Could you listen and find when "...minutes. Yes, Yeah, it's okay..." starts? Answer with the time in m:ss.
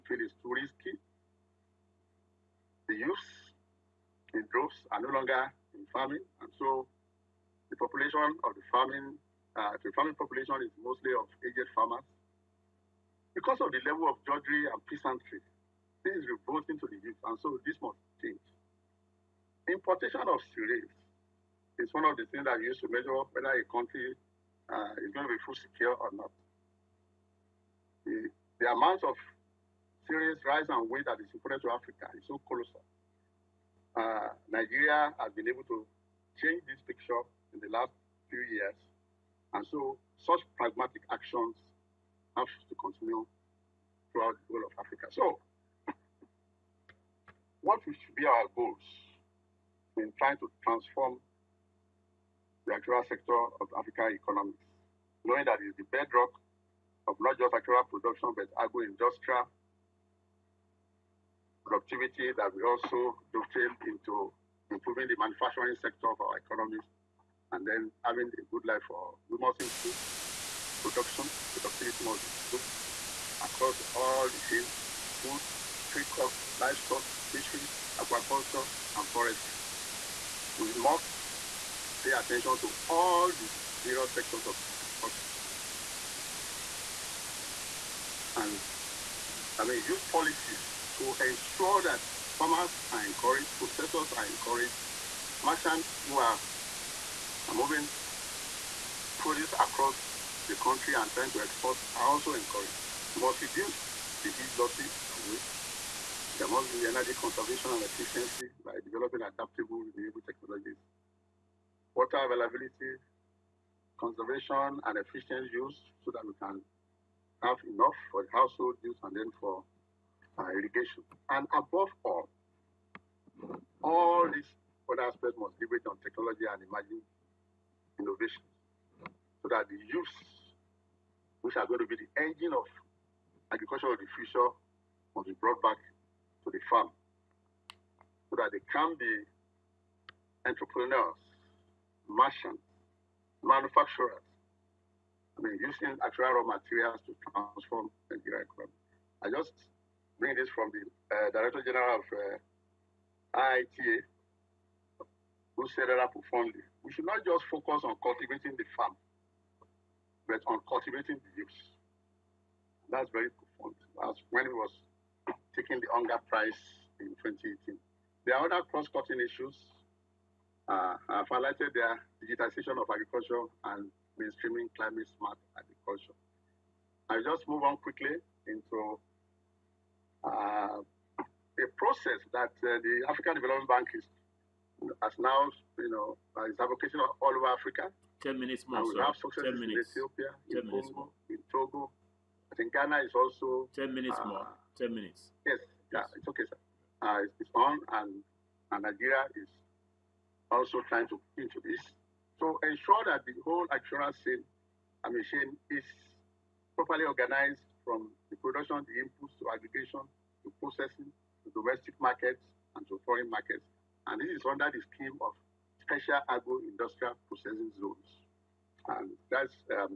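3:14.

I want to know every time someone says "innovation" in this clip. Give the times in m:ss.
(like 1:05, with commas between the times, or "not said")
2:07.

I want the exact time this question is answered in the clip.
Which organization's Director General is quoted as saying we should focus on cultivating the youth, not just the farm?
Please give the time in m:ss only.
2:33.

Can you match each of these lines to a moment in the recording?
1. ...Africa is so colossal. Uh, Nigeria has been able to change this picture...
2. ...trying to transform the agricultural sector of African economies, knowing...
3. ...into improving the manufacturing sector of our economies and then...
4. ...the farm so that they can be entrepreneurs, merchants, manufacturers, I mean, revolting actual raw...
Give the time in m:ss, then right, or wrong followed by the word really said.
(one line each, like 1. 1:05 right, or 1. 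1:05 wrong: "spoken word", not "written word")
1. 0:31 right
2. 0:50 right
3. 1:03 right
4. 2:16 wrong: "using", not "revolting".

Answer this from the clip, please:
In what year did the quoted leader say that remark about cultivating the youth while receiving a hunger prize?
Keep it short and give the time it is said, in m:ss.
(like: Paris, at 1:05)
2018, at 2:47.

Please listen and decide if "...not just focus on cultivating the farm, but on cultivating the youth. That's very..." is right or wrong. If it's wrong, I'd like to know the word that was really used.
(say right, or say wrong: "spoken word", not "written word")
right.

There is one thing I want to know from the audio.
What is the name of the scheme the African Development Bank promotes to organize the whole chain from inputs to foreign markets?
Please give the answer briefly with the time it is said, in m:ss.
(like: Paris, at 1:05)
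special agro-industrial processing zones, at 3:35.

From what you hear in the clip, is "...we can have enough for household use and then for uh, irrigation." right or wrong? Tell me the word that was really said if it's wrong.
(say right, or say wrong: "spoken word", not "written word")
right.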